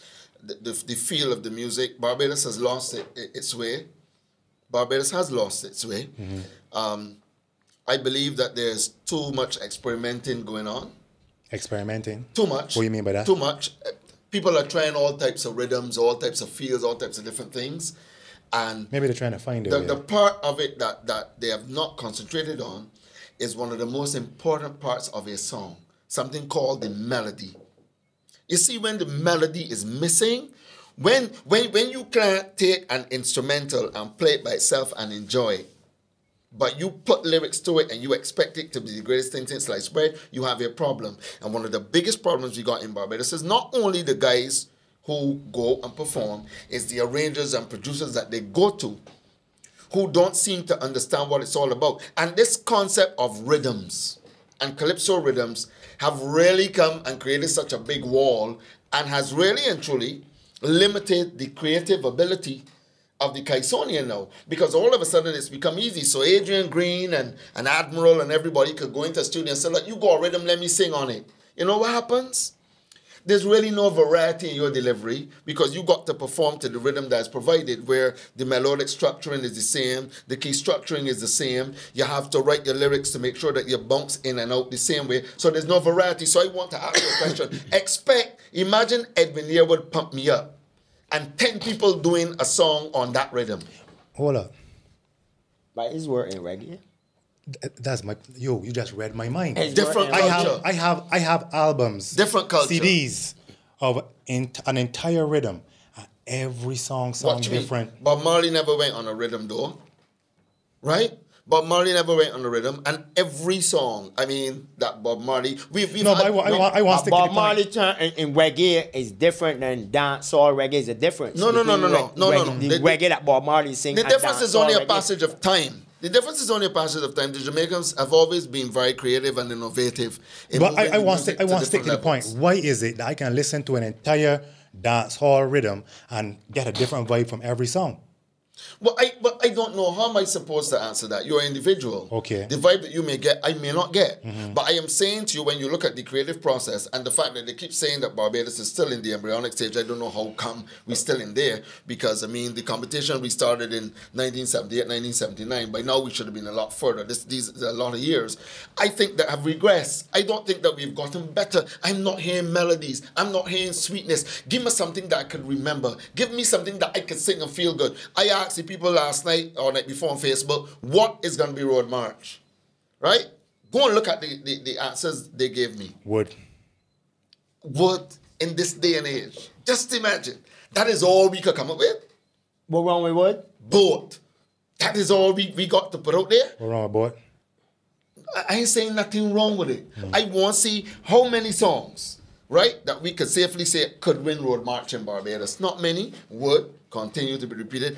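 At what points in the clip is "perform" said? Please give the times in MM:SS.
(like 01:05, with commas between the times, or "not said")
00:45, 01:16.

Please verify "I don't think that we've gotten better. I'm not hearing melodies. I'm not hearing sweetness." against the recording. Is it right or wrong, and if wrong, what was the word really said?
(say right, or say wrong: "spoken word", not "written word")
right.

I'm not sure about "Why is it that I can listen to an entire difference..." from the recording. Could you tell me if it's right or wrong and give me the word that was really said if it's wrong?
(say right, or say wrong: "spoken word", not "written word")
wrong: "dance", not "difference".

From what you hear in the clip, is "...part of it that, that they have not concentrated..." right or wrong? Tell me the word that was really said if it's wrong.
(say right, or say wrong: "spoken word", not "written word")
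right.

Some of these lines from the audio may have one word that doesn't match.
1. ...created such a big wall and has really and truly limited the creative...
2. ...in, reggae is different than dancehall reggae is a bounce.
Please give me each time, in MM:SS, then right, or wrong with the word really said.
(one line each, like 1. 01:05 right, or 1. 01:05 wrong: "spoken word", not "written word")
1. 00:57 right
2. 01:58 wrong: "difference", not "bounce".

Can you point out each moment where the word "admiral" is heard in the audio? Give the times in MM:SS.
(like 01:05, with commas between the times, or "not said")
01:07.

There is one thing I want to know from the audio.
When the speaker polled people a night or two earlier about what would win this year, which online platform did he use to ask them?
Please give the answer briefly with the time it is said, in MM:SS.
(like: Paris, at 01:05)
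Facebook, at 02:50.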